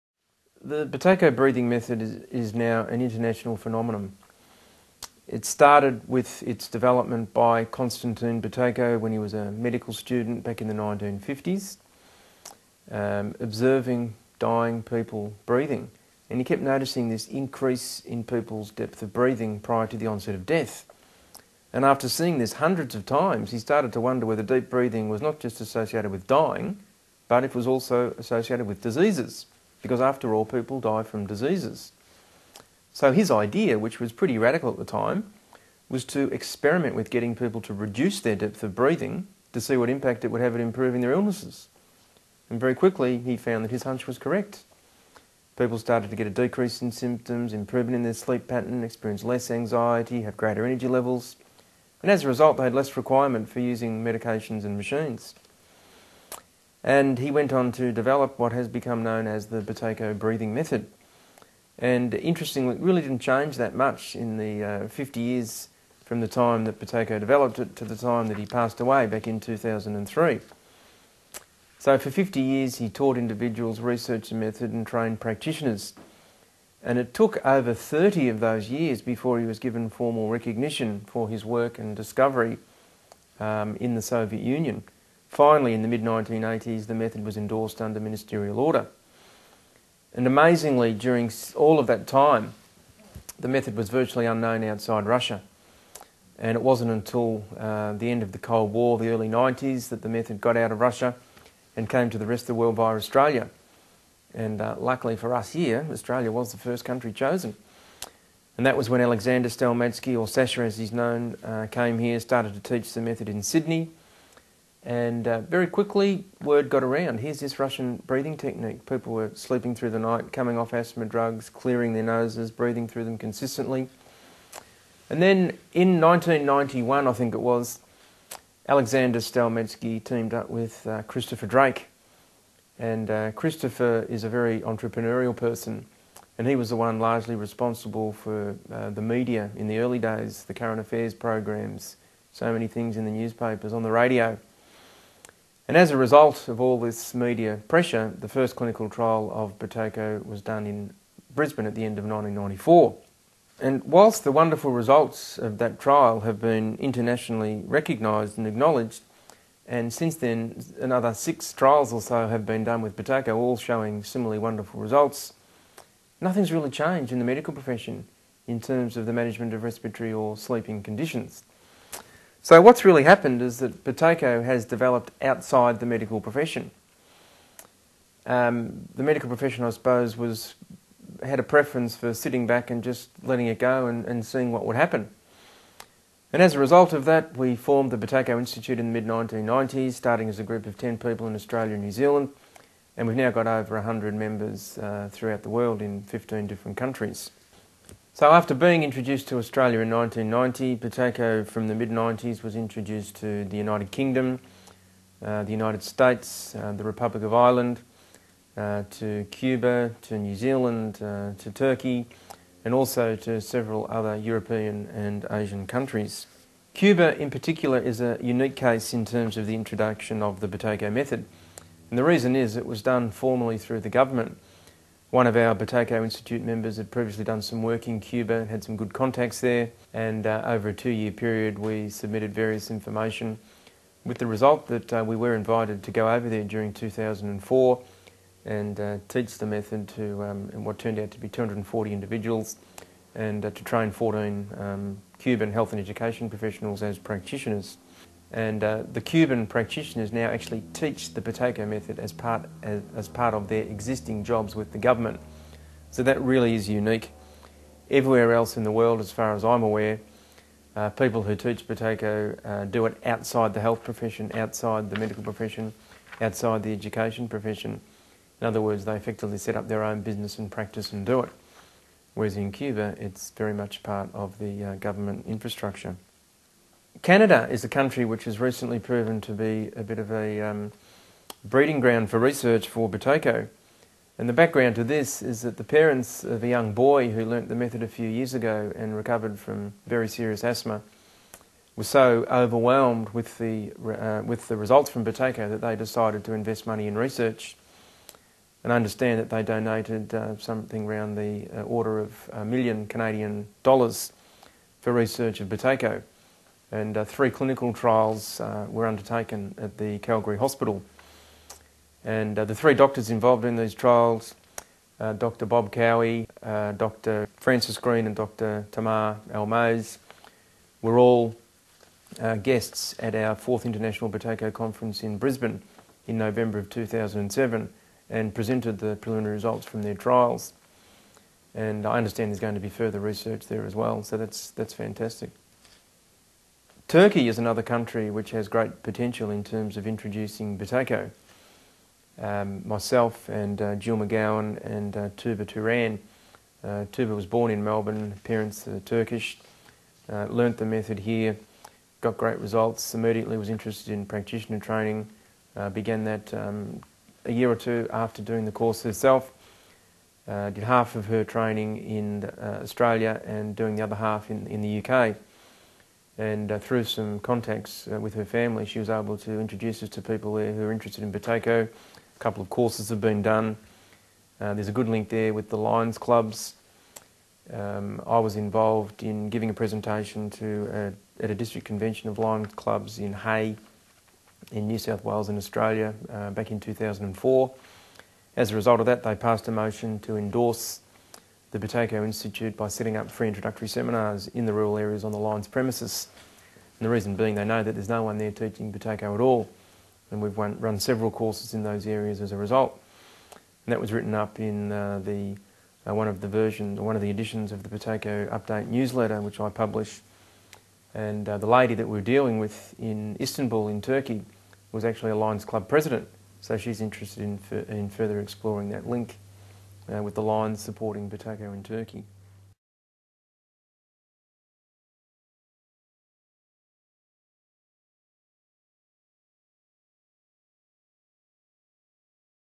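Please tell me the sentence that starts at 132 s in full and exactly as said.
And uh, Christopher is a very entrepreneurial person.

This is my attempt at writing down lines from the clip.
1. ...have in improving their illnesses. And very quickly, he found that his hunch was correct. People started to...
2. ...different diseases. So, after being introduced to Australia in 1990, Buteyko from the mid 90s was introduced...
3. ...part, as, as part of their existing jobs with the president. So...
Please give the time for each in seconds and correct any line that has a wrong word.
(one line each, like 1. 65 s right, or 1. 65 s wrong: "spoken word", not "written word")
1. 40 s right
2. 196 s wrong: "countries", not "diseases"
3. 252 s wrong: "government", not "president".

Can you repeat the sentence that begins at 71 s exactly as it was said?
So for 50 years he taught individuals, researched the method and trained practitioners.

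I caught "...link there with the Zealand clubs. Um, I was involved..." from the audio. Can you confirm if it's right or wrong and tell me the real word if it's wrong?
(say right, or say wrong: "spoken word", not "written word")
wrong: "Lions", not "Zealand".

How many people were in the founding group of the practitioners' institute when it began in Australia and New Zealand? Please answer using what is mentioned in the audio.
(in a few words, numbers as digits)
10.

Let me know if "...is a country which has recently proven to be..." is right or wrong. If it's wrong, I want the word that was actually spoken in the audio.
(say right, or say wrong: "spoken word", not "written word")
right.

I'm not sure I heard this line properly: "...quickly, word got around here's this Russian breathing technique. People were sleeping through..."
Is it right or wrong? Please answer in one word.
right.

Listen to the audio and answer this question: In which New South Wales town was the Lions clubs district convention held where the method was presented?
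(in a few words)
Hay.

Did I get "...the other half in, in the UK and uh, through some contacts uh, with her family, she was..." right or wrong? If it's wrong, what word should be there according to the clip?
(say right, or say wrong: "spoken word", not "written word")
right.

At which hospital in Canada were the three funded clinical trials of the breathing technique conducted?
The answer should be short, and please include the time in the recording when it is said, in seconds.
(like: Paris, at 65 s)
Calgary Hospital, at 309 s.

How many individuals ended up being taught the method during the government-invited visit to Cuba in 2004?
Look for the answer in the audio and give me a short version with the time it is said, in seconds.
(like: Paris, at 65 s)
240, at 241 s.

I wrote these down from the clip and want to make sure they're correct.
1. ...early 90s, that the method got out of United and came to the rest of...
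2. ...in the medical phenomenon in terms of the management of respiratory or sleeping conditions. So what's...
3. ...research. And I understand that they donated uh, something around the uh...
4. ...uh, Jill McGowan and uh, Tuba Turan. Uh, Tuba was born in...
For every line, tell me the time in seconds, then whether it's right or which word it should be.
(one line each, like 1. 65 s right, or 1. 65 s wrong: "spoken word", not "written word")
1. 99 s wrong: "Russia", not "United"
2. 167 s wrong: "profession", not "phenomenon"
3. 296 s right
4. 343 s right.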